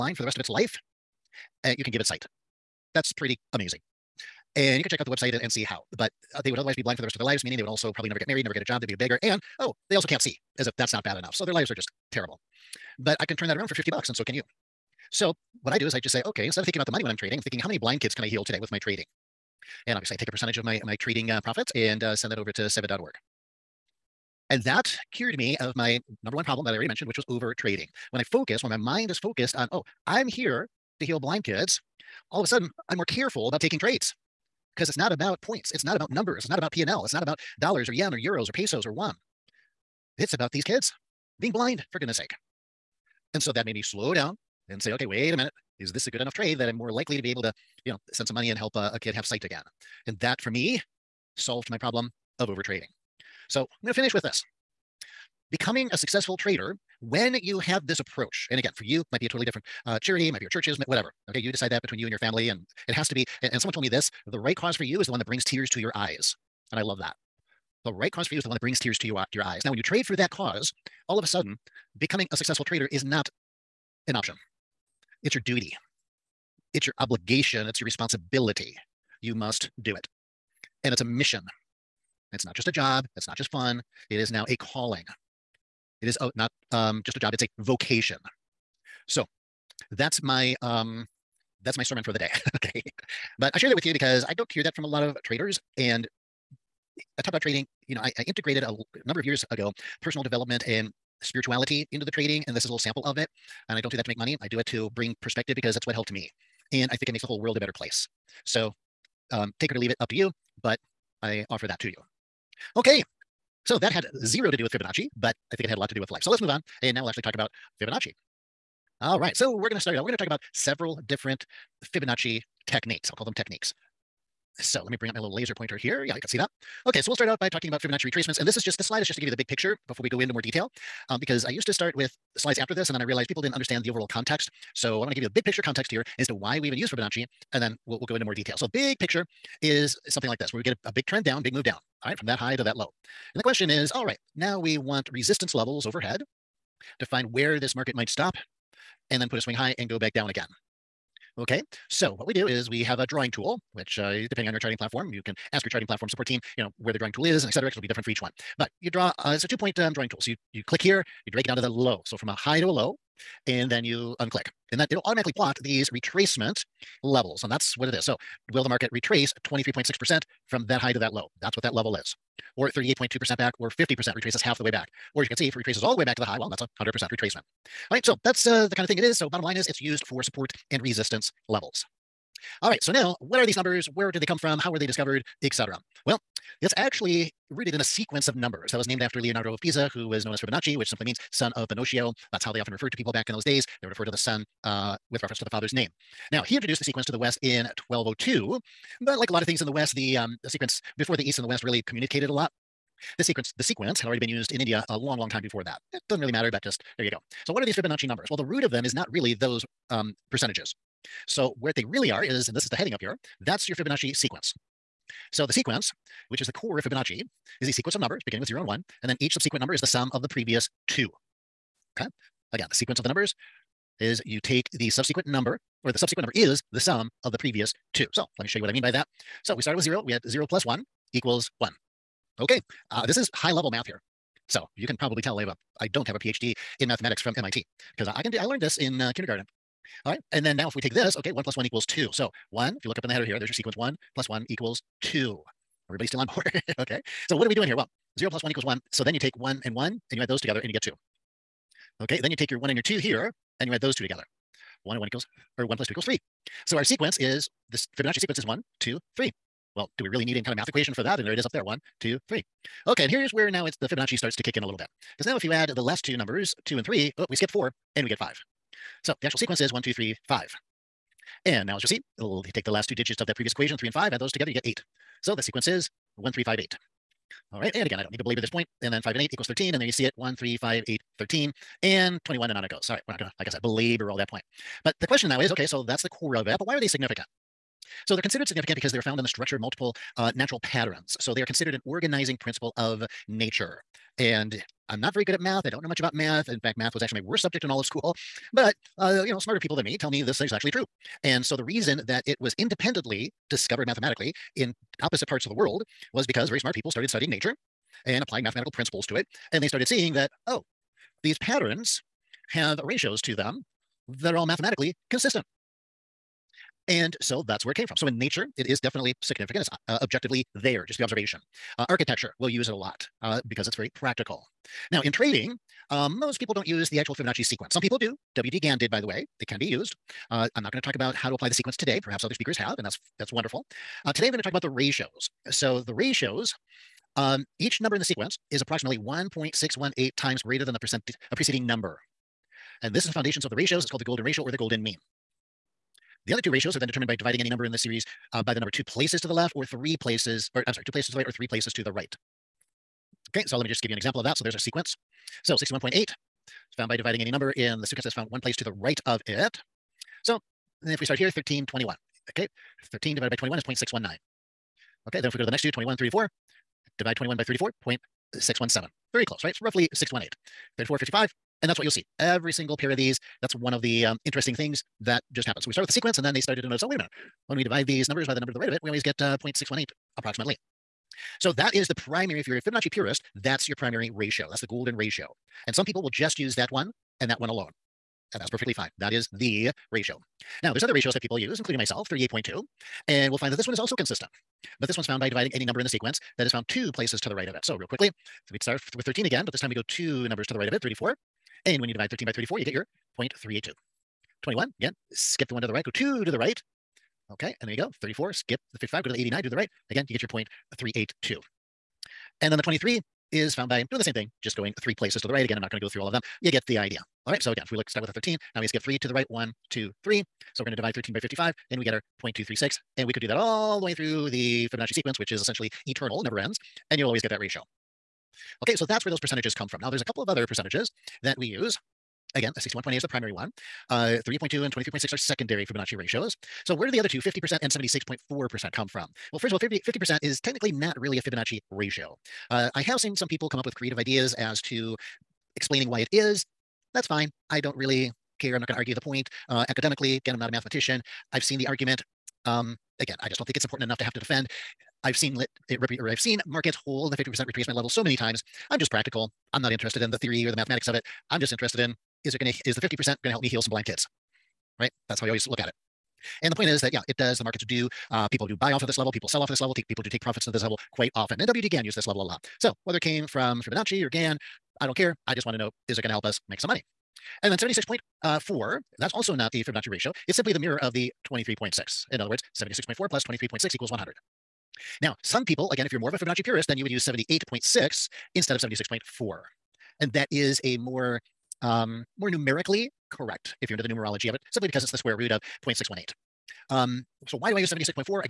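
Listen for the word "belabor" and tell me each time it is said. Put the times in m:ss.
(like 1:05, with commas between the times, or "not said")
4:38, 4:43.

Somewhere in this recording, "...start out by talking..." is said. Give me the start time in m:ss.
2:07.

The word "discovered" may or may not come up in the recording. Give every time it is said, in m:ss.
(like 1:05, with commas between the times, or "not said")
3:04, 5:03.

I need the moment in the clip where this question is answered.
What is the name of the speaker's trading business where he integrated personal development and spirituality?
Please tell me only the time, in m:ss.
1:37.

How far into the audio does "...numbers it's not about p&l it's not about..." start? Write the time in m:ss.
0:36.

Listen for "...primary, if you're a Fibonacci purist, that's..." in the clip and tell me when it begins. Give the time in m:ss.
6:21.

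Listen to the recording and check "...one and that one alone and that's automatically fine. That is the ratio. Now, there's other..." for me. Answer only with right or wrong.
wrong.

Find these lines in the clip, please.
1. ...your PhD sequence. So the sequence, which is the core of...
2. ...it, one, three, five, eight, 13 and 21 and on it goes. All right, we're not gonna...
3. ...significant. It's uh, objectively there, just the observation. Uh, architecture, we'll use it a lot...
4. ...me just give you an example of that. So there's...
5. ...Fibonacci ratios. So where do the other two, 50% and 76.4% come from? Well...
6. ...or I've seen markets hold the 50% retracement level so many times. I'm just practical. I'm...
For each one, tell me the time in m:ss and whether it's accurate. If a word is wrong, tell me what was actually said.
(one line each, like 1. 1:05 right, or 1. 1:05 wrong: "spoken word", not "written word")
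1. 3:33 wrong: "Fibonacci", not "PhD"
2. 4:40 right
3. 5:19 right
4. 5:53 right
5. 7:15 right
6. 7:35 right.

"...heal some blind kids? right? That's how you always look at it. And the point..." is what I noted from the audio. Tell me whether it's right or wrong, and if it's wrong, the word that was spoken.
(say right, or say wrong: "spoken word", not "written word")
right.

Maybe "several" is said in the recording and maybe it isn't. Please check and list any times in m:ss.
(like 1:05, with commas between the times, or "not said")
2:00.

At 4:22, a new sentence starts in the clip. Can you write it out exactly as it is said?
Okay, and here's where now it's the Fibonacci starts to kick in a little bit.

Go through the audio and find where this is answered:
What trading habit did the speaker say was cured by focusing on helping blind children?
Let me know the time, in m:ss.
0:27.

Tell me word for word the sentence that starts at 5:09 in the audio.
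And they started seeing that, oh, these patterns have ratios to them that are all mathematically consistent.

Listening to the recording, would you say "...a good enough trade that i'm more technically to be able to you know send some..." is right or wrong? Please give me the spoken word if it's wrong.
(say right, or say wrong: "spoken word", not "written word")
wrong: "likely", not "technically".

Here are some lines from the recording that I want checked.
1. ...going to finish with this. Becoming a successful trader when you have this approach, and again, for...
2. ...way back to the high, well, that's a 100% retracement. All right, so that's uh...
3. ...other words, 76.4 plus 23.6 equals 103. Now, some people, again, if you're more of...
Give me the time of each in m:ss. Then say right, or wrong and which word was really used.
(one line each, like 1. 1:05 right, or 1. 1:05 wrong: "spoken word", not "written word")
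1. 0:53 right
2. 2:55 right
3. 8:02 wrong: "100", not "103".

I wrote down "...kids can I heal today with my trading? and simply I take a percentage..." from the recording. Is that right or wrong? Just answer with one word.
wrong.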